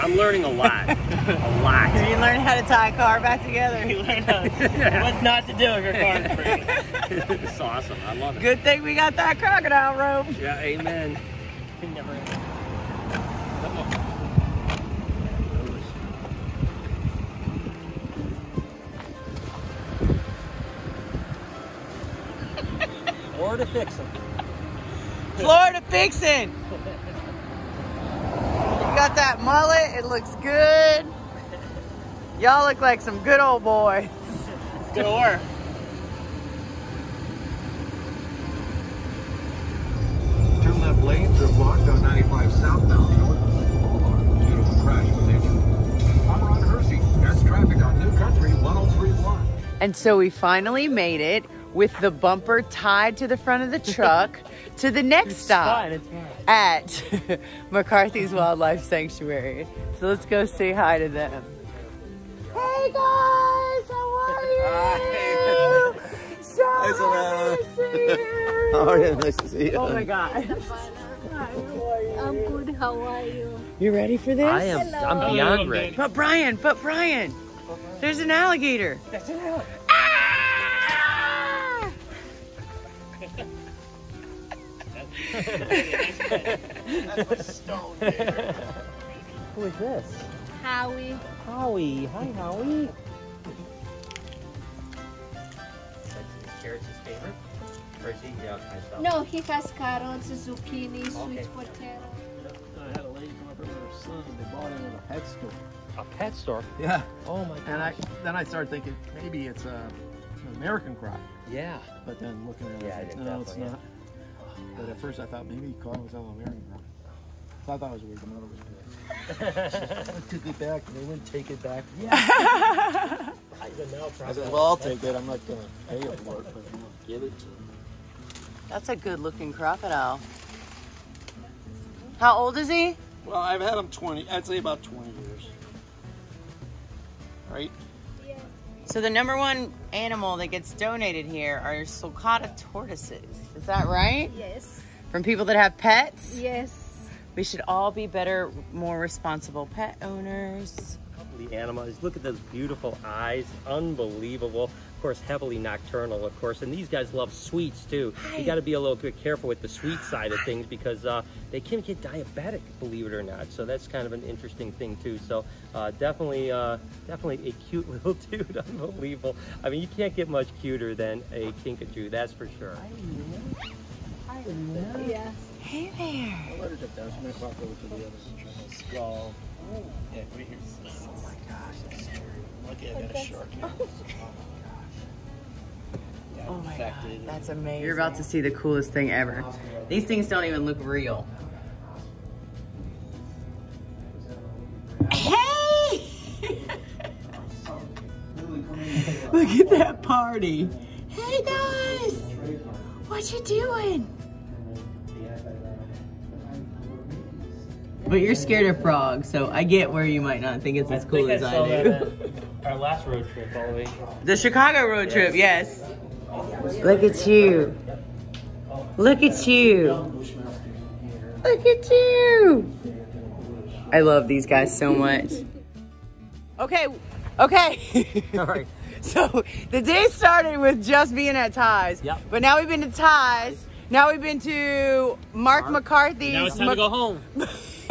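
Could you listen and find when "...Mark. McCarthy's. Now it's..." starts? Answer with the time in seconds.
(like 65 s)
235 s.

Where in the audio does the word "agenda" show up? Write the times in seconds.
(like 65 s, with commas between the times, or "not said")
not said.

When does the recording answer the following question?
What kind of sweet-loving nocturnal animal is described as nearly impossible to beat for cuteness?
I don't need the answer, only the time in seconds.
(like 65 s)
171 s.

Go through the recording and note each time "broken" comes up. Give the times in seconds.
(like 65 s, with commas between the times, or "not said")
7 s.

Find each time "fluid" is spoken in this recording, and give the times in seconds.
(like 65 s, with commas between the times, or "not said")
not said.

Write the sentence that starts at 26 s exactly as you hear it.
You got that mullet, it looks good.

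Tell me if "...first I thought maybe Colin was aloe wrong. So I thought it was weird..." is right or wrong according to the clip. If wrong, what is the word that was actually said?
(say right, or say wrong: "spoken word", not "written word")
right.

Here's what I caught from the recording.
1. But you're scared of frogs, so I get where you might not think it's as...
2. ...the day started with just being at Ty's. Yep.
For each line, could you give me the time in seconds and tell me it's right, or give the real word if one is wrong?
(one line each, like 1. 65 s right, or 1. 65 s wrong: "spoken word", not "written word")
1. 208 s right
2. 229 s right.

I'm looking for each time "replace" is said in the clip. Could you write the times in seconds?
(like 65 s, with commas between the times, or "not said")
not said.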